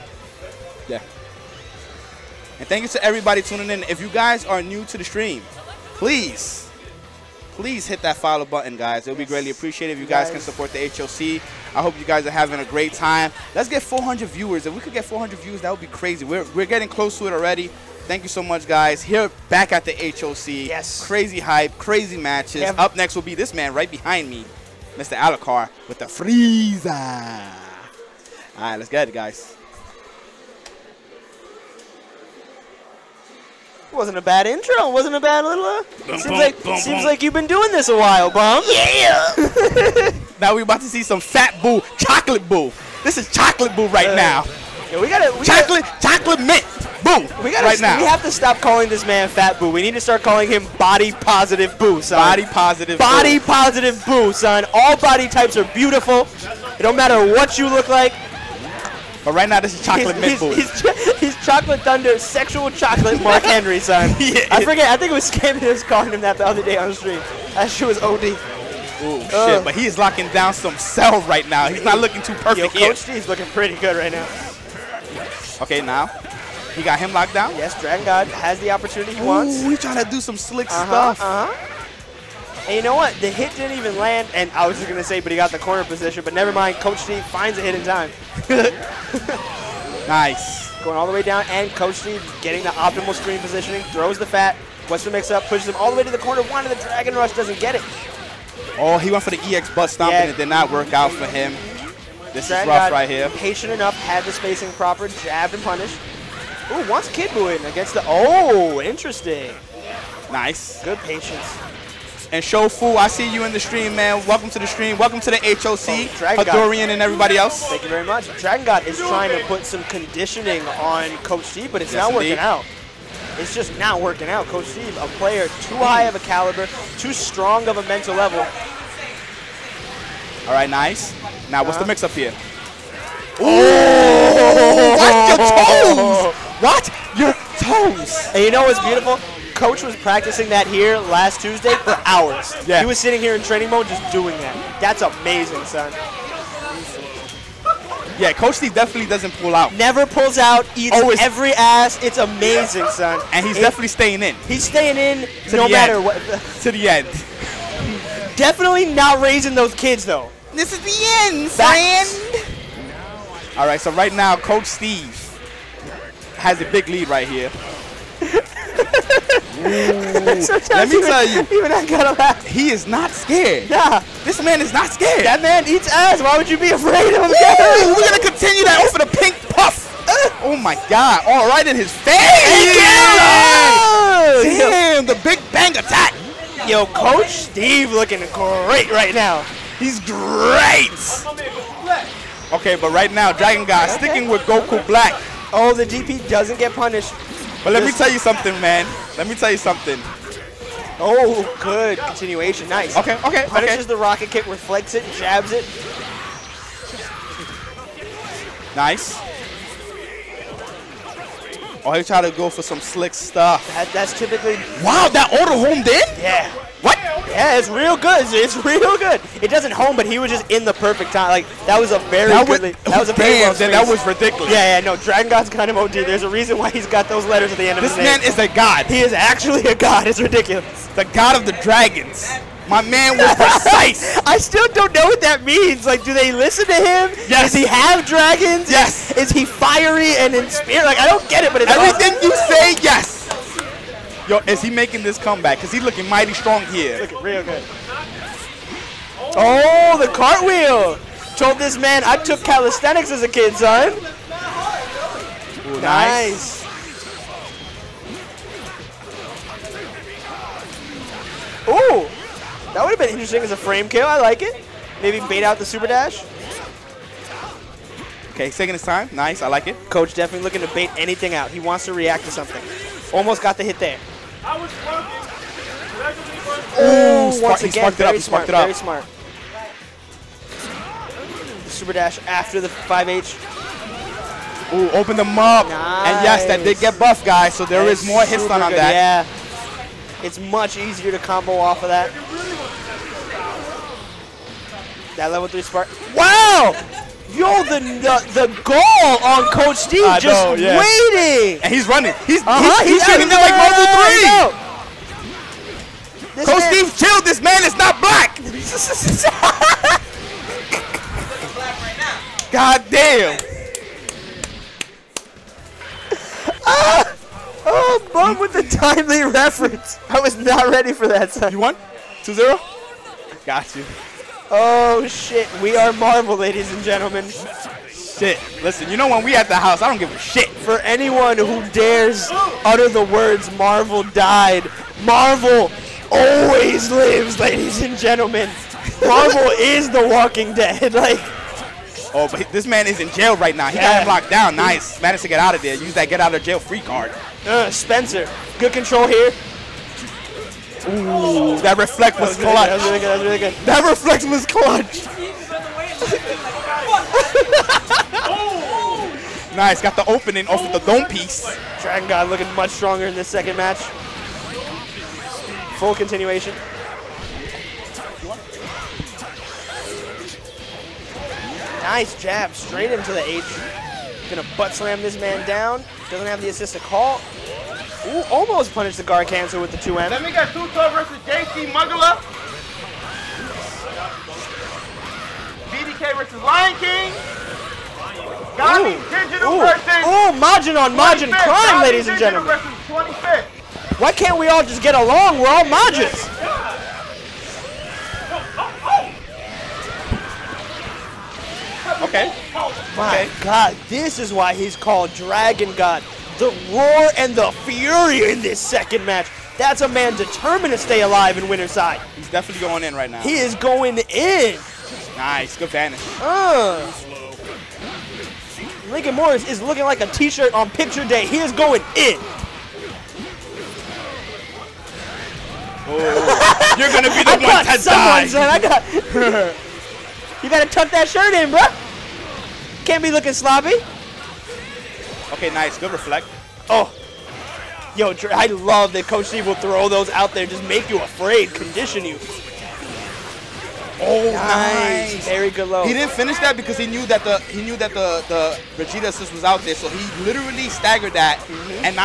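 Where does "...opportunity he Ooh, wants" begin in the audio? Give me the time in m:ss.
1:18.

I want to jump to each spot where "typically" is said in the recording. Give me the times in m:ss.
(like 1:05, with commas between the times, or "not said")
3:34.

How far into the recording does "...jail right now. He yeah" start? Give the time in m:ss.
5:43.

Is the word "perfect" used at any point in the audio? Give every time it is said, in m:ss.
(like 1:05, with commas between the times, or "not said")
1:12, 3:40.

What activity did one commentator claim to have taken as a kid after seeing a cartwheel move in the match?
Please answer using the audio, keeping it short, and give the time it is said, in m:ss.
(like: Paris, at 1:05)
Calisthenics, at 4:12.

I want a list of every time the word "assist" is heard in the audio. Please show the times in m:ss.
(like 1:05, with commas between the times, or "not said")
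6:16, 7:29.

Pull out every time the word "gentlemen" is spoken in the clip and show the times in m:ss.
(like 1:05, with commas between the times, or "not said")
5:26, 5:37, 6:32.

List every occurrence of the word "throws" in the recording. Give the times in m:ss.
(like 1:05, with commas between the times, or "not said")
1:33, 7:19.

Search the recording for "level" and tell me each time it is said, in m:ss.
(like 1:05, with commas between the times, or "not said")
2:08, 4:55.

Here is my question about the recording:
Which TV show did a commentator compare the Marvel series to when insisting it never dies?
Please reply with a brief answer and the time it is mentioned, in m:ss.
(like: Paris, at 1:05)
The Walking Dead, at 5:39.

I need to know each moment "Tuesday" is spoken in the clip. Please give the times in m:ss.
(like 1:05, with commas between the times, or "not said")
2:21.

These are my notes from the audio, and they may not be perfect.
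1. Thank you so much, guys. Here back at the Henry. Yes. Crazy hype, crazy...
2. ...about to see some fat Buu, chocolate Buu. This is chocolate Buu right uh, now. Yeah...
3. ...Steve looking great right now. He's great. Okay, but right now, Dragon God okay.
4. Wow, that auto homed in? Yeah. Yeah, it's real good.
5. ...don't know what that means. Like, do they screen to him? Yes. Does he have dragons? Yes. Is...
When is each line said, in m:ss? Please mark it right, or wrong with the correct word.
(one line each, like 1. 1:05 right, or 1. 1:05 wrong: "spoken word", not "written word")
1. 0:18 wrong: "HOC", not "Henry"
2. 0:40 right
3. 3:07 right
4. 3:34 right
5. 3:54 wrong: "listen", not "screen".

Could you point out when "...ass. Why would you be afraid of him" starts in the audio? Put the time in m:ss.
2:55.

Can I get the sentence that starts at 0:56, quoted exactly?
It don't matter what you look like.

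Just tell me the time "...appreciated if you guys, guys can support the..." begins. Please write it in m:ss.
0:09.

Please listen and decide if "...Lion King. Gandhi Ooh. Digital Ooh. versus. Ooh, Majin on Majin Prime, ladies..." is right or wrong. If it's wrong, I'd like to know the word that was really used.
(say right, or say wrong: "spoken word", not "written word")
right.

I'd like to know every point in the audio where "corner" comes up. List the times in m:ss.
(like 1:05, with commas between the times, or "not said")
1:25, 1:36.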